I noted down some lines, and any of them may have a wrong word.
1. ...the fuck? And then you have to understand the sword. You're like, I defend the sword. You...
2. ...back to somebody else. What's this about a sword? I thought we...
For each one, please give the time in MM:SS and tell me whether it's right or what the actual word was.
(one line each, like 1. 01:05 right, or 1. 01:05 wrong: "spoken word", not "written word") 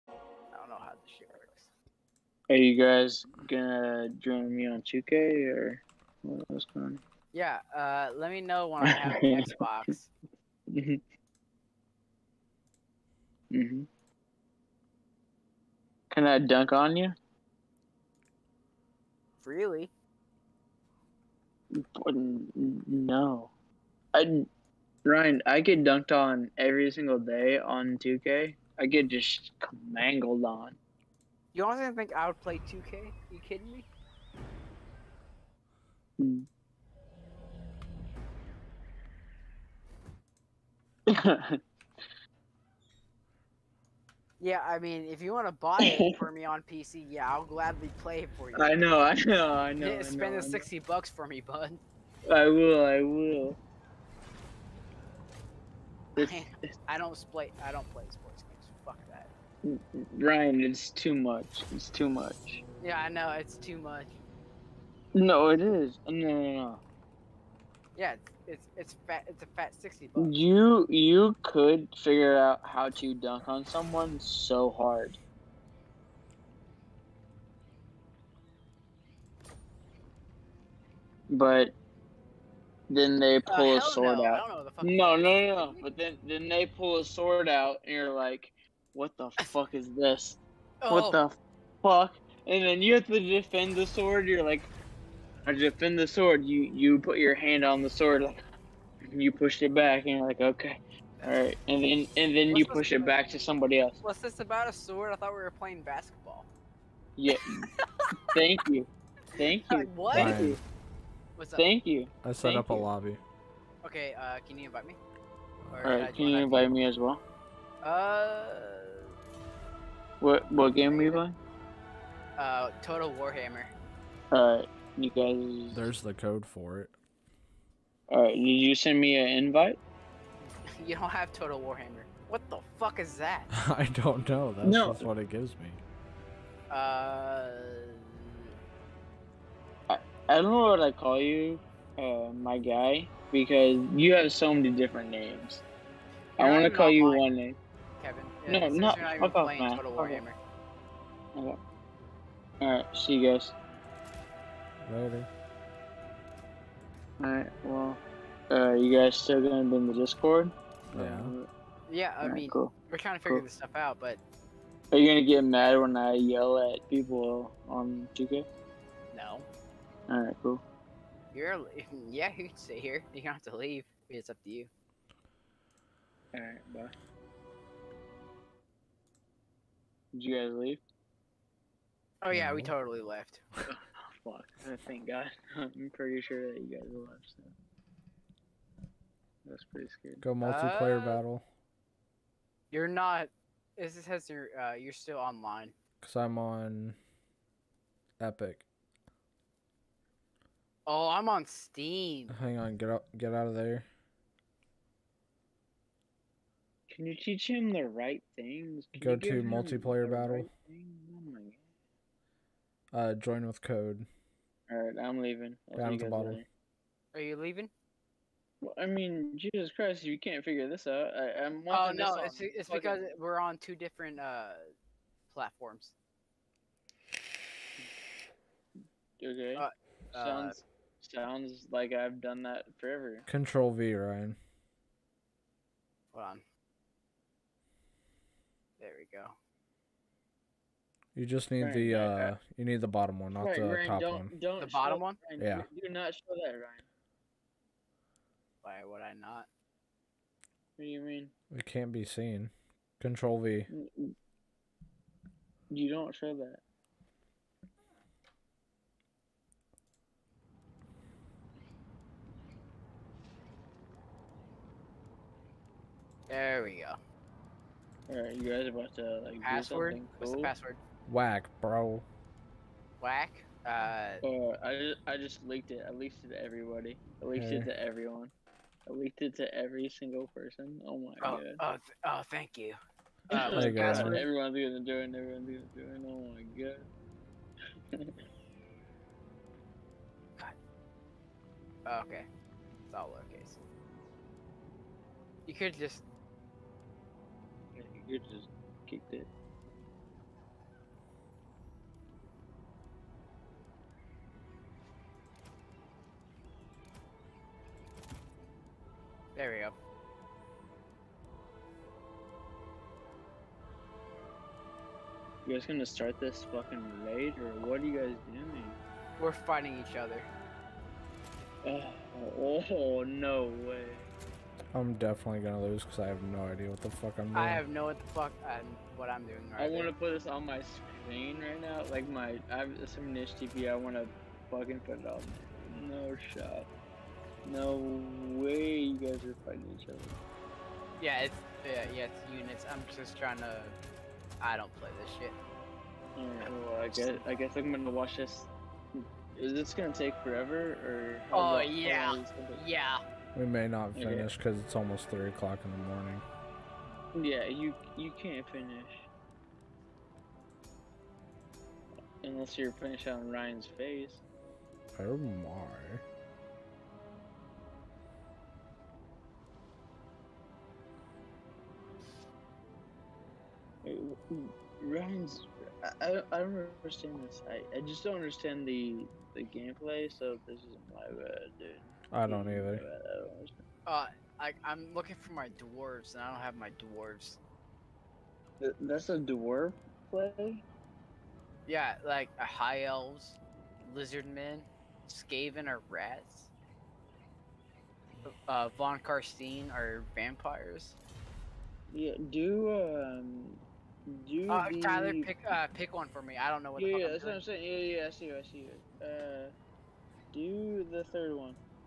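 1. 01:31 wrong: "defend", not "understand"
2. 01:43 right.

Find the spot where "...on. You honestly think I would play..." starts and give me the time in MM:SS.
00:30.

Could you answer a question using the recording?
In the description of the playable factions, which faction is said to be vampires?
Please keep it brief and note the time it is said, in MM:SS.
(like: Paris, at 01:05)
Von Karstein, at 06:38.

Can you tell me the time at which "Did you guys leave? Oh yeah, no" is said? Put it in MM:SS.
03:00.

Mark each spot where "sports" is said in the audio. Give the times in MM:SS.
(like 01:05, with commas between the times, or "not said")
00:58.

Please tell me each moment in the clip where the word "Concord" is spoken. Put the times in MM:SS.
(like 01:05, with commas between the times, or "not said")
not said.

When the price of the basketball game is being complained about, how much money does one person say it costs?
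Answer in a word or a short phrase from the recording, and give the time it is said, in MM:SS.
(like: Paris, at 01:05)
60 bucks, at 00:50.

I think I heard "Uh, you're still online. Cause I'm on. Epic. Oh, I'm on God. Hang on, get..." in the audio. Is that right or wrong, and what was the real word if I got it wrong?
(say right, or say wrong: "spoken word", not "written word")
wrong: "Steam", not "God".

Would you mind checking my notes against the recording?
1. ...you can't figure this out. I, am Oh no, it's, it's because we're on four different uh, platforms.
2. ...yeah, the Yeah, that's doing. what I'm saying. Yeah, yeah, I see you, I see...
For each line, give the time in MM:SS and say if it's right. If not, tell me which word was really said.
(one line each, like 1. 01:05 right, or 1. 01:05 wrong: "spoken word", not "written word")
1. 03:40 wrong: "two", not "four"
2. 06:46 right.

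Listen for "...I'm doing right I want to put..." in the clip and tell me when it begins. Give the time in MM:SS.
05:29.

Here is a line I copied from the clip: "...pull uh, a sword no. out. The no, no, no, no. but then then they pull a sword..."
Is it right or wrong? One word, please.
right.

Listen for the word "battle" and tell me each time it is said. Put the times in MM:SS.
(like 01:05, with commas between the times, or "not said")
03:11, 03:30.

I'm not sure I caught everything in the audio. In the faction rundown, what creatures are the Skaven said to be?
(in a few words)
rats.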